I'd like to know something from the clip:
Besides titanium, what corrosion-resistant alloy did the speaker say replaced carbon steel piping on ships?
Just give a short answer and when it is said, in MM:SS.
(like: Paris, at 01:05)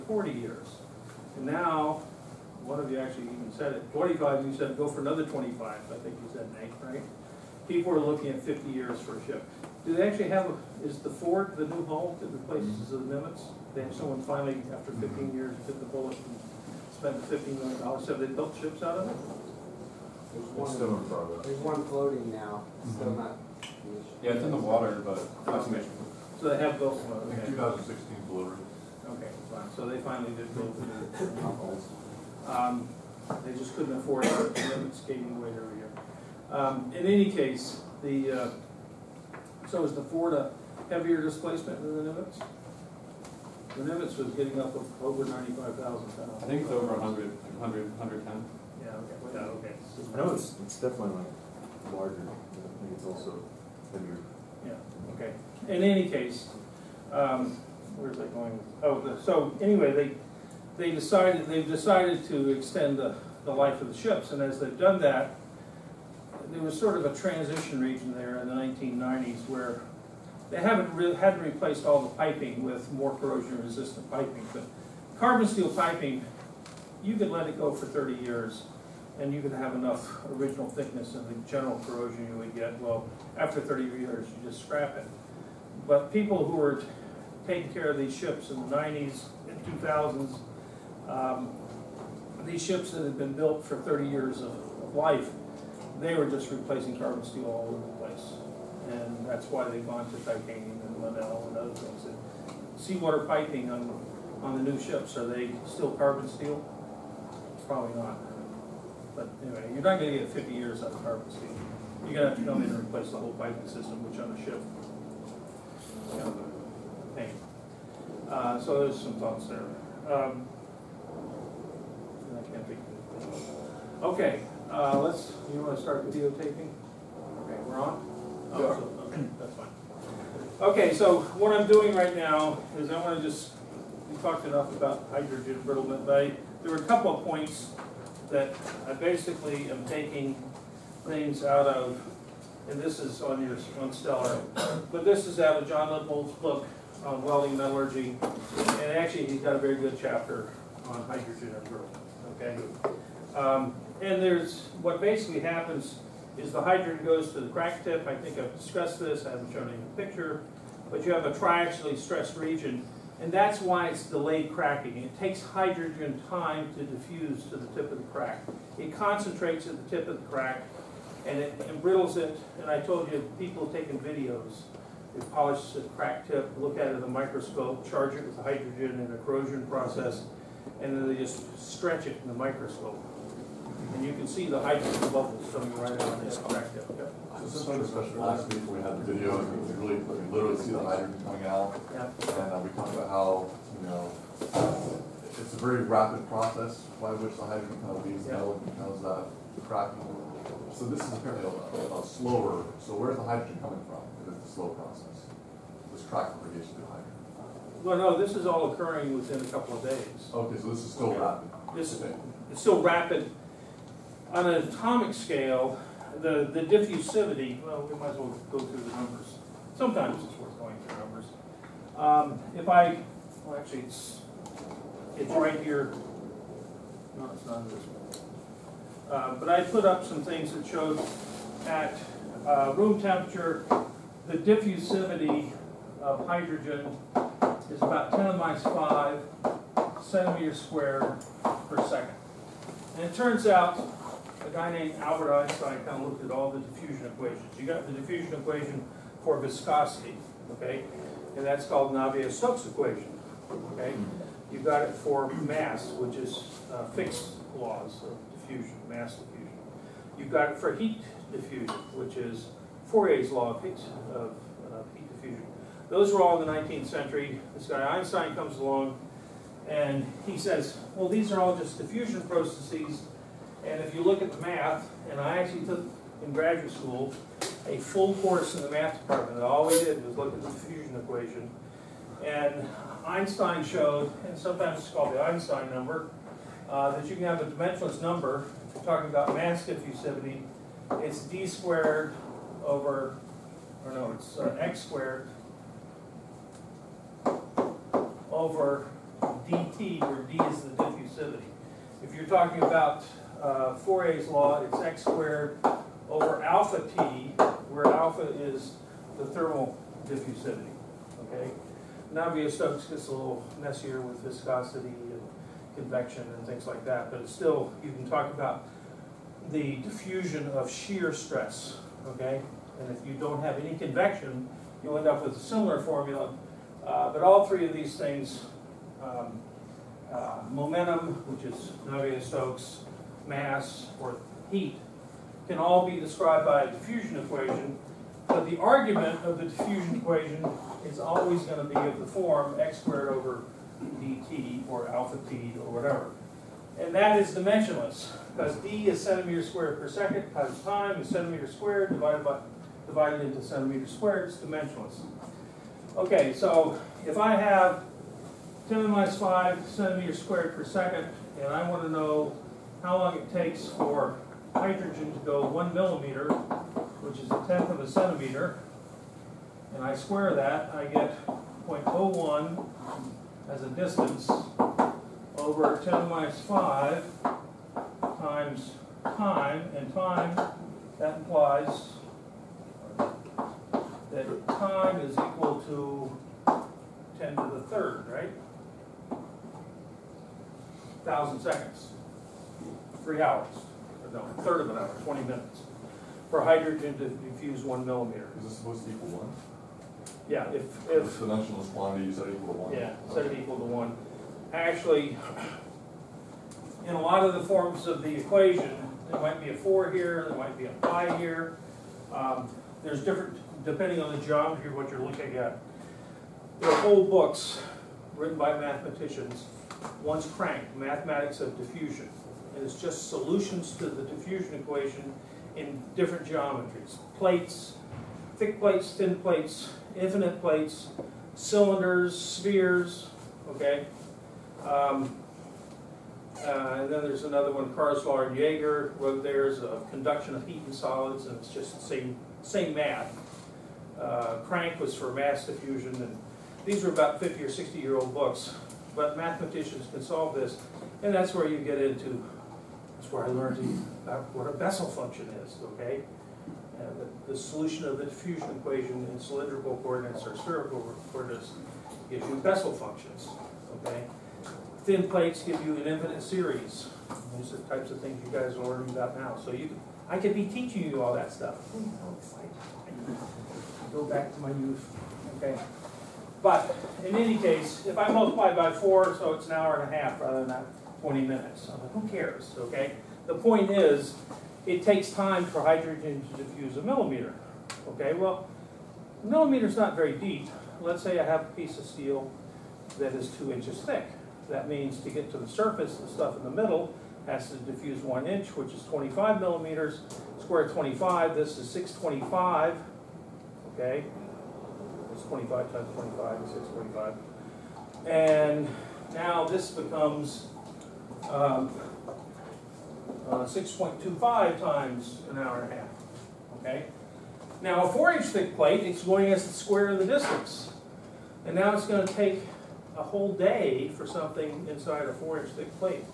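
Inconel, at 01:40.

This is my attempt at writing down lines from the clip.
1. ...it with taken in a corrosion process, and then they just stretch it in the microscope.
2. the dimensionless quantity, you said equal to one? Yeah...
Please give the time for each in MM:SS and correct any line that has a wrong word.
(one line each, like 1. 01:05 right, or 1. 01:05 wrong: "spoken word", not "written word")
1. 02:58 wrong: "hydrogen", not "taken"
2. 06:41 right.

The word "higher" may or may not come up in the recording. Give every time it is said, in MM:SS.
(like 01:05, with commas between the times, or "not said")
03:26.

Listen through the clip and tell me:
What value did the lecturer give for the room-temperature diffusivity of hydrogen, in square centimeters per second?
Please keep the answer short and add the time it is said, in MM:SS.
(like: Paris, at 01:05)
10^-5, at 03:58.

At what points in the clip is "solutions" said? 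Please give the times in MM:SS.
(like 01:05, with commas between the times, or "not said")
07:03, 07:37.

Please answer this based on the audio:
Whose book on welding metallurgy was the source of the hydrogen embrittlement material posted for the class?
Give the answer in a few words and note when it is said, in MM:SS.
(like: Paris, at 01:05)
John Lippold, at 02:25.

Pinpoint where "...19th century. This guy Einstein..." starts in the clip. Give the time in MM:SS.
04:26.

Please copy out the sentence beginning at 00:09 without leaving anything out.
Do they actually have, a, is the Ford the new hull that of the Nimitz?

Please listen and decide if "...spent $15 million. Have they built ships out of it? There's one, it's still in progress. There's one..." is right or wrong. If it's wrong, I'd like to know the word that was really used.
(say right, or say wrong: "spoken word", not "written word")
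right.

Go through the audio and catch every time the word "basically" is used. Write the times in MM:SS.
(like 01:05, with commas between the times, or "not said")
02:18, 02:35.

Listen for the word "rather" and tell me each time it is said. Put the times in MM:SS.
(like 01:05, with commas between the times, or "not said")
08:00.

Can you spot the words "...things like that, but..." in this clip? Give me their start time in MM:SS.
05:16.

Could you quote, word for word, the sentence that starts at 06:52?
Um, there's different, depending on the geometry of what you're looking at.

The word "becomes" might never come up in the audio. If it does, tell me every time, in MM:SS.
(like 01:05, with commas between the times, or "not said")
03:18, 08:29.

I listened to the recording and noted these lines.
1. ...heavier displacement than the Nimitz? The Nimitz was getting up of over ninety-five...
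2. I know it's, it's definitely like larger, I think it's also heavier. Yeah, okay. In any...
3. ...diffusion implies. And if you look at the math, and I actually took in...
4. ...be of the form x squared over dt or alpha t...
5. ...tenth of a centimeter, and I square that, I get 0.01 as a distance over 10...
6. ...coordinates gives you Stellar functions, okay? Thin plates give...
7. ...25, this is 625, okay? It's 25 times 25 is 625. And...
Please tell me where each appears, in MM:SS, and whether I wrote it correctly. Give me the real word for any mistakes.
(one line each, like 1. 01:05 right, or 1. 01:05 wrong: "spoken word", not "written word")
1. 00:40 right
2. 00:50 right
3. 04:31 wrong: "processes", not "implies"
4. 05:41 right
5. 06:07 right
6. 07:41 wrong: "Bessel", not "Stellar"
7. 08:20 right.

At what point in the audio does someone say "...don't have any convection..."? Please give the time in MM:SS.
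05:23.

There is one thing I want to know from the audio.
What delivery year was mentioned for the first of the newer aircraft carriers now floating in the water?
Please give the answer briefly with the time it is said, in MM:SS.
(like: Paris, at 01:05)
2016, at 00:27.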